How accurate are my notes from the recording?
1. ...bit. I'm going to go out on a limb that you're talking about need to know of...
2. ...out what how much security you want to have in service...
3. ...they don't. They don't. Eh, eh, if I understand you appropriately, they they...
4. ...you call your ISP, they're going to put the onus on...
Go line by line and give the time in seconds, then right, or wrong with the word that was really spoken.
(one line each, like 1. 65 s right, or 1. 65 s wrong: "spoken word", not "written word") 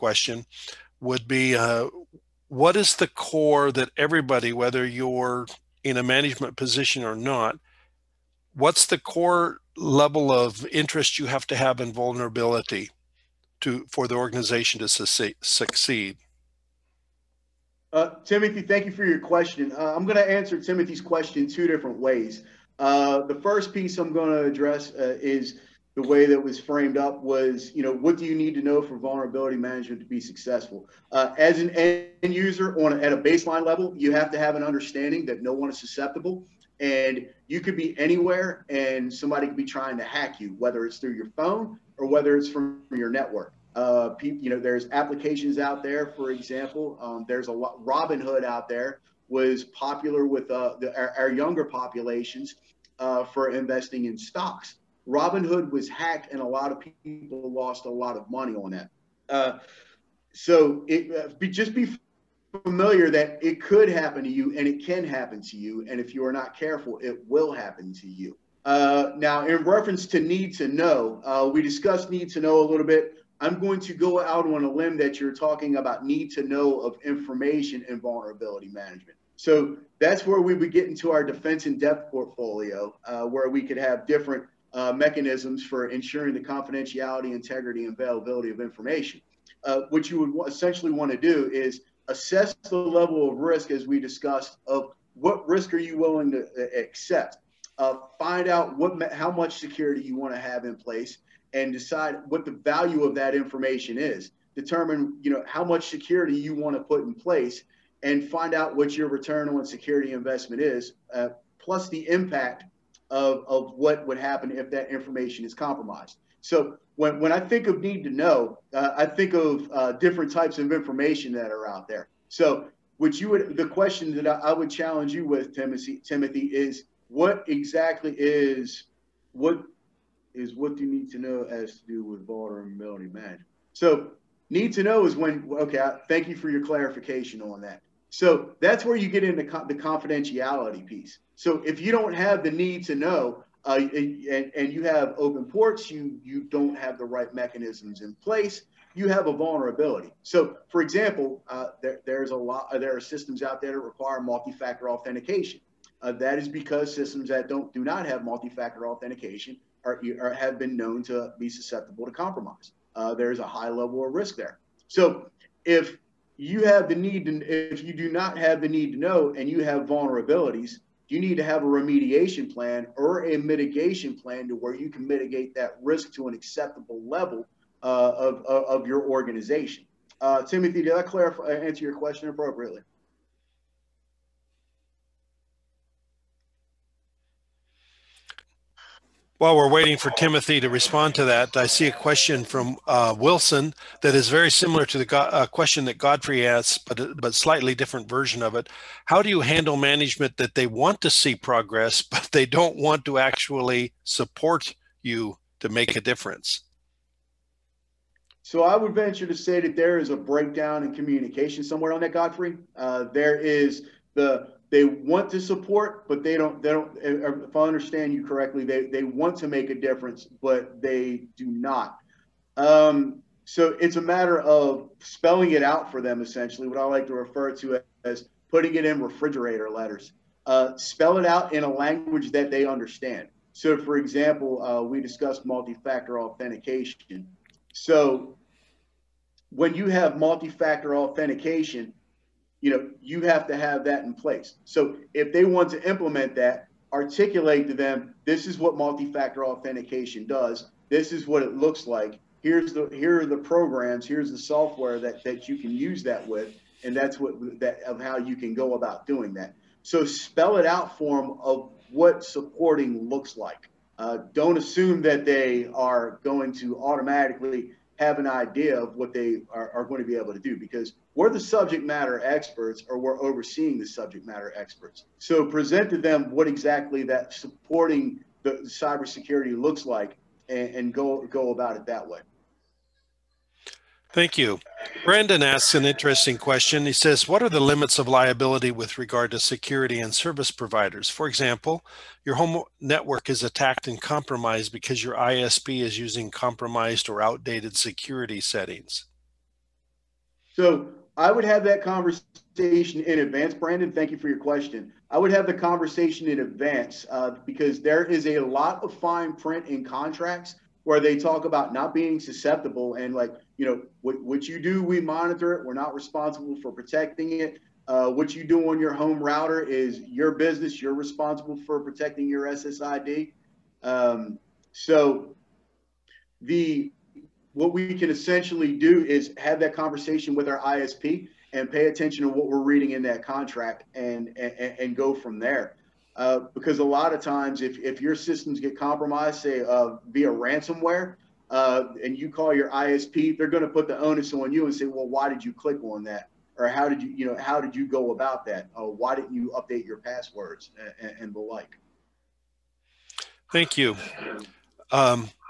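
1. 72 s right
2. 98 s wrong: "place", not "service"
3. 216 s wrong: "correctly", not "appropriately"
4. 342 s right.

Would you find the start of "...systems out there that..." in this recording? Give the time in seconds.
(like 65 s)
152 s.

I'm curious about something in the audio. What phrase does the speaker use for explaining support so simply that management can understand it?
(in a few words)
refrigerator letters.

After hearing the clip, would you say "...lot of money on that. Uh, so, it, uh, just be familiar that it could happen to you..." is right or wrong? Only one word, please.
right.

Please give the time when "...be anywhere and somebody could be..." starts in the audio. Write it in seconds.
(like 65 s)
37 s.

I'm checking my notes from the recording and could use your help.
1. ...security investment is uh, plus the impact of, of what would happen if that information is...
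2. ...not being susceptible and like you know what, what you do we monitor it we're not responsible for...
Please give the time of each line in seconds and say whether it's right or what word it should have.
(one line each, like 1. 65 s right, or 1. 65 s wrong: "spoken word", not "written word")
1. 109 s right
2. 311 s right.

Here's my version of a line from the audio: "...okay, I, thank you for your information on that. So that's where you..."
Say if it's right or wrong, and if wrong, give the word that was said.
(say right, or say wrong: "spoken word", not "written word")
wrong: "clarification", not "information".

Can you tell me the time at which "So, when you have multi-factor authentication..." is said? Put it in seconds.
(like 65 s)
237 s.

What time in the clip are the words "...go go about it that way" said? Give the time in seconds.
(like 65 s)
280 s.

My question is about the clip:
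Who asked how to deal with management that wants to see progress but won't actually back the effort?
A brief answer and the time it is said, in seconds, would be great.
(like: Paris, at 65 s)
Wilson, at 193 s.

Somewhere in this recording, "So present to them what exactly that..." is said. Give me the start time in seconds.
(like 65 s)
275 s.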